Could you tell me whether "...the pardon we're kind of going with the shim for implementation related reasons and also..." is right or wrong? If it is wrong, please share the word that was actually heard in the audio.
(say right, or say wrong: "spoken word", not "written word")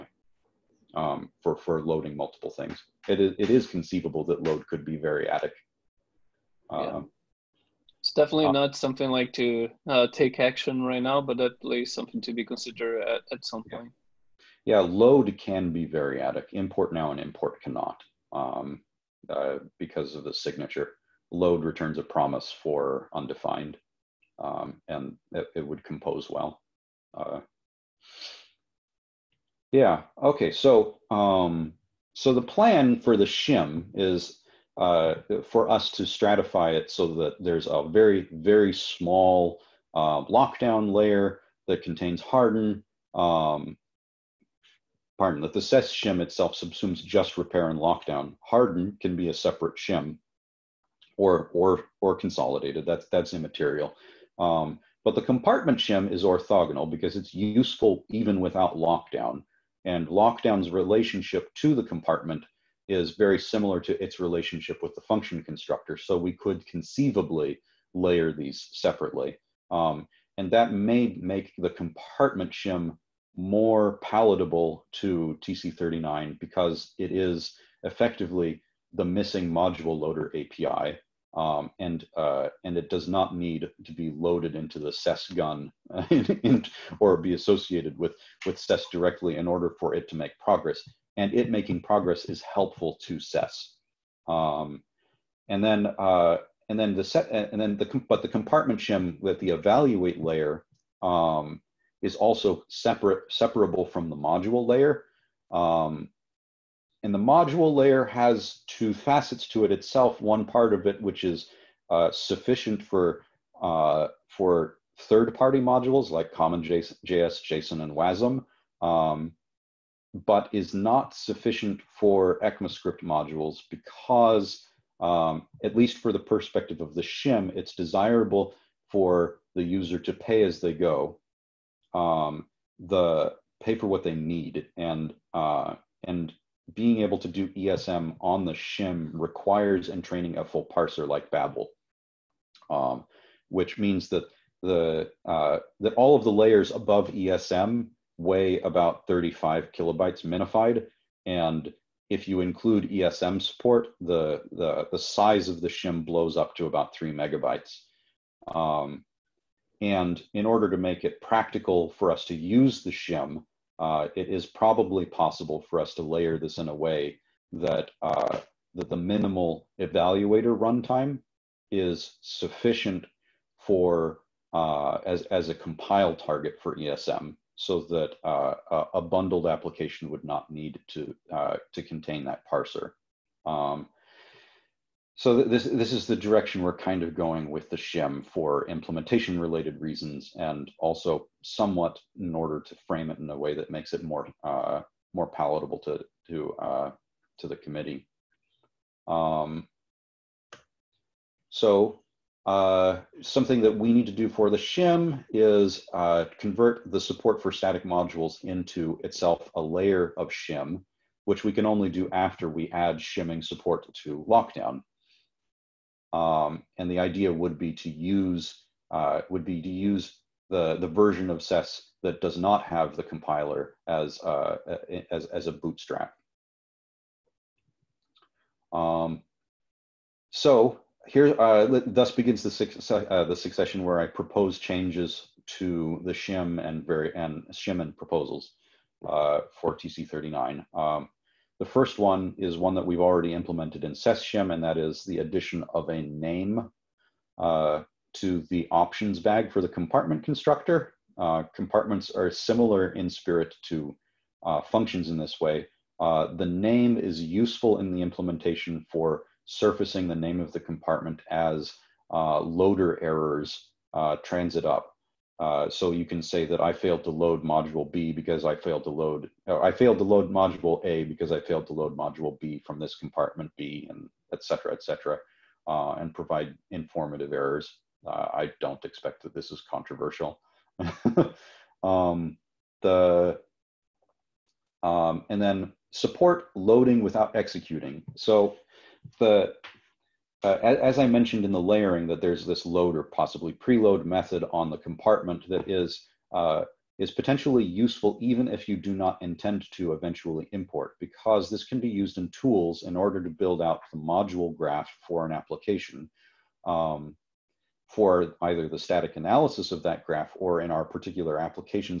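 wrong: "direction", not "pardon".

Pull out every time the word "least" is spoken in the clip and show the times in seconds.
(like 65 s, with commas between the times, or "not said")
11 s, 125 s.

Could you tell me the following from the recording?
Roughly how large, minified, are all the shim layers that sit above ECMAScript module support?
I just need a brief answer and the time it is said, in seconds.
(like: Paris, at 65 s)
35 kilobytes, at 149 s.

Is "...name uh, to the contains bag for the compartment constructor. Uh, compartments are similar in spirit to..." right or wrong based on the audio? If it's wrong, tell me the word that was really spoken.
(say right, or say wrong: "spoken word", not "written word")
wrong: "options", not "contains".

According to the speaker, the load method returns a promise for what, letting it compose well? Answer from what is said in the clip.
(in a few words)
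undefined.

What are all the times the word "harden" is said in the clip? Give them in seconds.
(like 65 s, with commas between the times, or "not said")
42 s, 48 s.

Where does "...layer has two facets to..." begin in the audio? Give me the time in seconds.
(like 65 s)
107 s.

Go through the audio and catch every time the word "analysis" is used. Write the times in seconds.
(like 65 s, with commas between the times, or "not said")
309 s.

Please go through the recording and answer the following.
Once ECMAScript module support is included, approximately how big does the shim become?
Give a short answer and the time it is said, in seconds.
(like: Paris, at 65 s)
3 megabytes, at 156 s.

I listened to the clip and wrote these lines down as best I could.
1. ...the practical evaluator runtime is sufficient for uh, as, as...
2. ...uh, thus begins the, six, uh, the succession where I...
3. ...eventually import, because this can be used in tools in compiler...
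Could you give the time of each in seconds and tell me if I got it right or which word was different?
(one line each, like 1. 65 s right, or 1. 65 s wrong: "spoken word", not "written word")
1. 168 s wrong: "minimal", not "practical"
2. 231 s right
3. 299 s wrong: "order", not "compiler".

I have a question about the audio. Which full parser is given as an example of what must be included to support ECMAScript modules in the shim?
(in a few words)
Babel.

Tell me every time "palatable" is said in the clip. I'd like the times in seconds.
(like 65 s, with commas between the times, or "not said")
74 s, 195 s.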